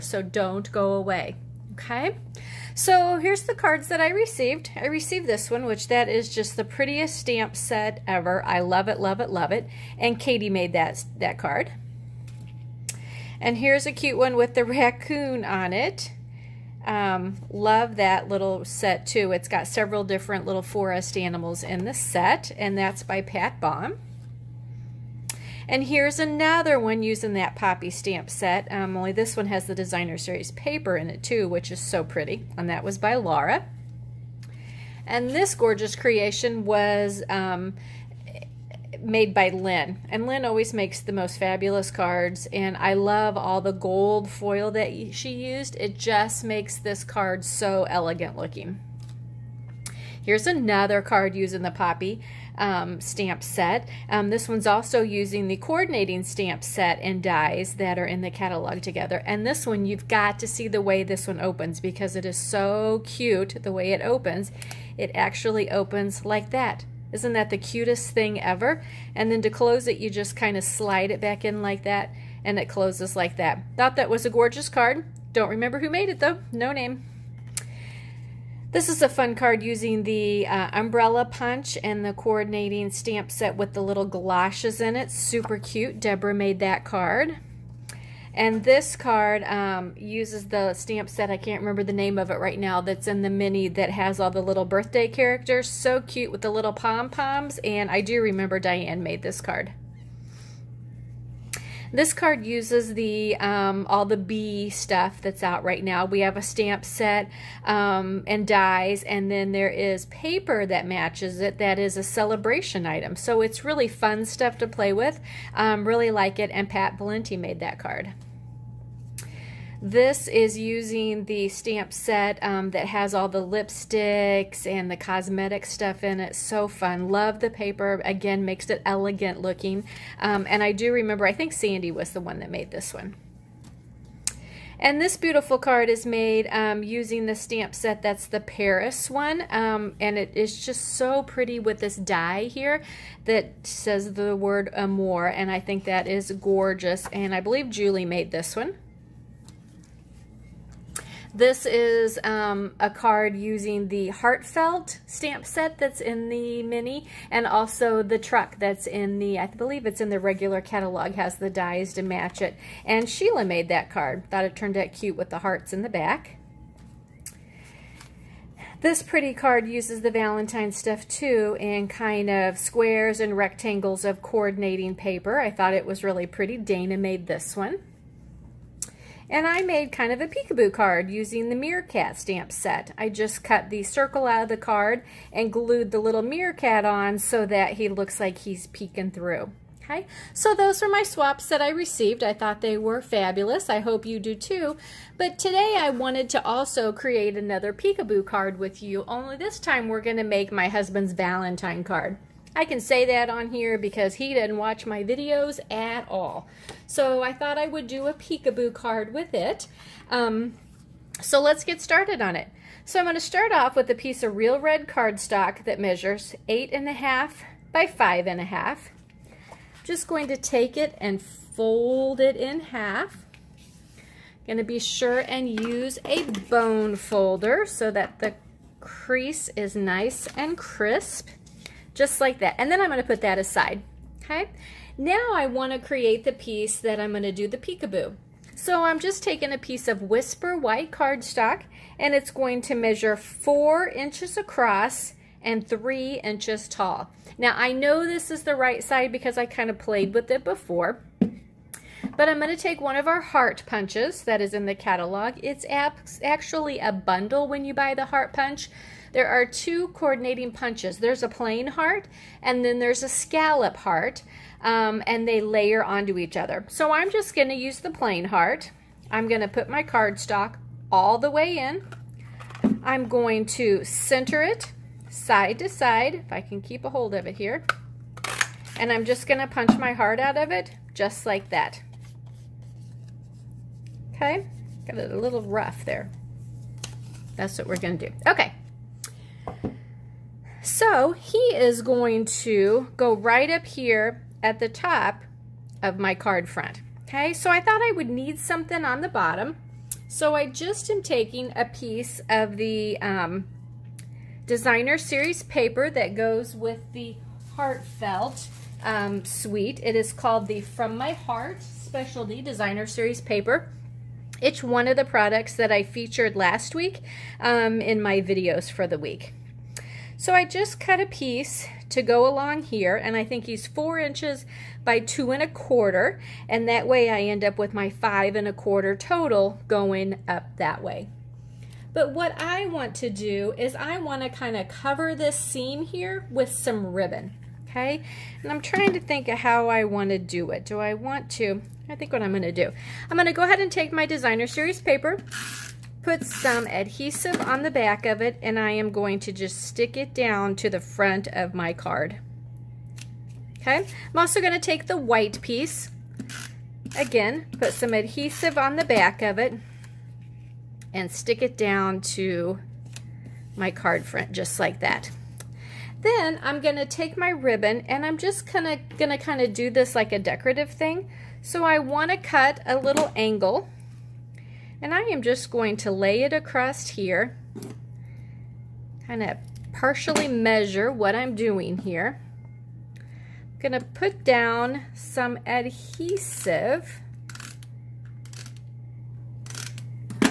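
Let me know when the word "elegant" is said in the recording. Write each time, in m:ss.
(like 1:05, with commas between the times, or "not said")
0:47, 2:08.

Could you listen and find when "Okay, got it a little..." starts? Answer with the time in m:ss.
4:44.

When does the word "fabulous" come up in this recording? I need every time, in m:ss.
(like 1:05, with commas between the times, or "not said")
0:41, 3:13.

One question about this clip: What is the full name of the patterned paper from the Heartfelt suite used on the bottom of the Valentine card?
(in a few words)
From My Heart Specialty Designer Series paper.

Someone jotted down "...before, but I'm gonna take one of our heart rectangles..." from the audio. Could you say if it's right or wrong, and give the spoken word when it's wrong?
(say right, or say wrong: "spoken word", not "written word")
wrong: "punches", not "rectangles".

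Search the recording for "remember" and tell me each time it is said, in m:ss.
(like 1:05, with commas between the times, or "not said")
1:15, 1:31, 1:38, 2:10.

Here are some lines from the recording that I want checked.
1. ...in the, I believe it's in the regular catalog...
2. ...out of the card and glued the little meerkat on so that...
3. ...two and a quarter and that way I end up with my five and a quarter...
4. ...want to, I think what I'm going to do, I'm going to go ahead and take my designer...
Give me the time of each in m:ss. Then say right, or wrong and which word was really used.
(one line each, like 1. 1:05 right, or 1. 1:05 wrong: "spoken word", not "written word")
1. 2:38 right
2. 3:04 right
3. 5:24 right
4. 5:40 right.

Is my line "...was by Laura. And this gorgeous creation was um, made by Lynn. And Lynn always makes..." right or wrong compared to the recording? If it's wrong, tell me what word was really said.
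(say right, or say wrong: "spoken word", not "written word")
right.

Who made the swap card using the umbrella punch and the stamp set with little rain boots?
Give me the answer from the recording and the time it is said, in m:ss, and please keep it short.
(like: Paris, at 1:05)
Deborah, at 1:25.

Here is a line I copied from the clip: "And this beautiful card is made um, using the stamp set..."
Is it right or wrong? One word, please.
right.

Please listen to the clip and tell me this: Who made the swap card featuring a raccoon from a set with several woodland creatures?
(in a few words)
Pat Baum.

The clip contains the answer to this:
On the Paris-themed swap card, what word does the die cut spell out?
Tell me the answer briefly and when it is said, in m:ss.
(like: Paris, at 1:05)
amour, at 2:24.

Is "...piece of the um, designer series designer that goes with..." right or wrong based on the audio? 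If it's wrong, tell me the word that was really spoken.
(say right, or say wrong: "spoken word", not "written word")
wrong: "paper", not "designer".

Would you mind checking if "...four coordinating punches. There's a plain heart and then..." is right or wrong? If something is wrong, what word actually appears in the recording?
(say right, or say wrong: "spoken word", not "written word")
wrong: "two", not "four".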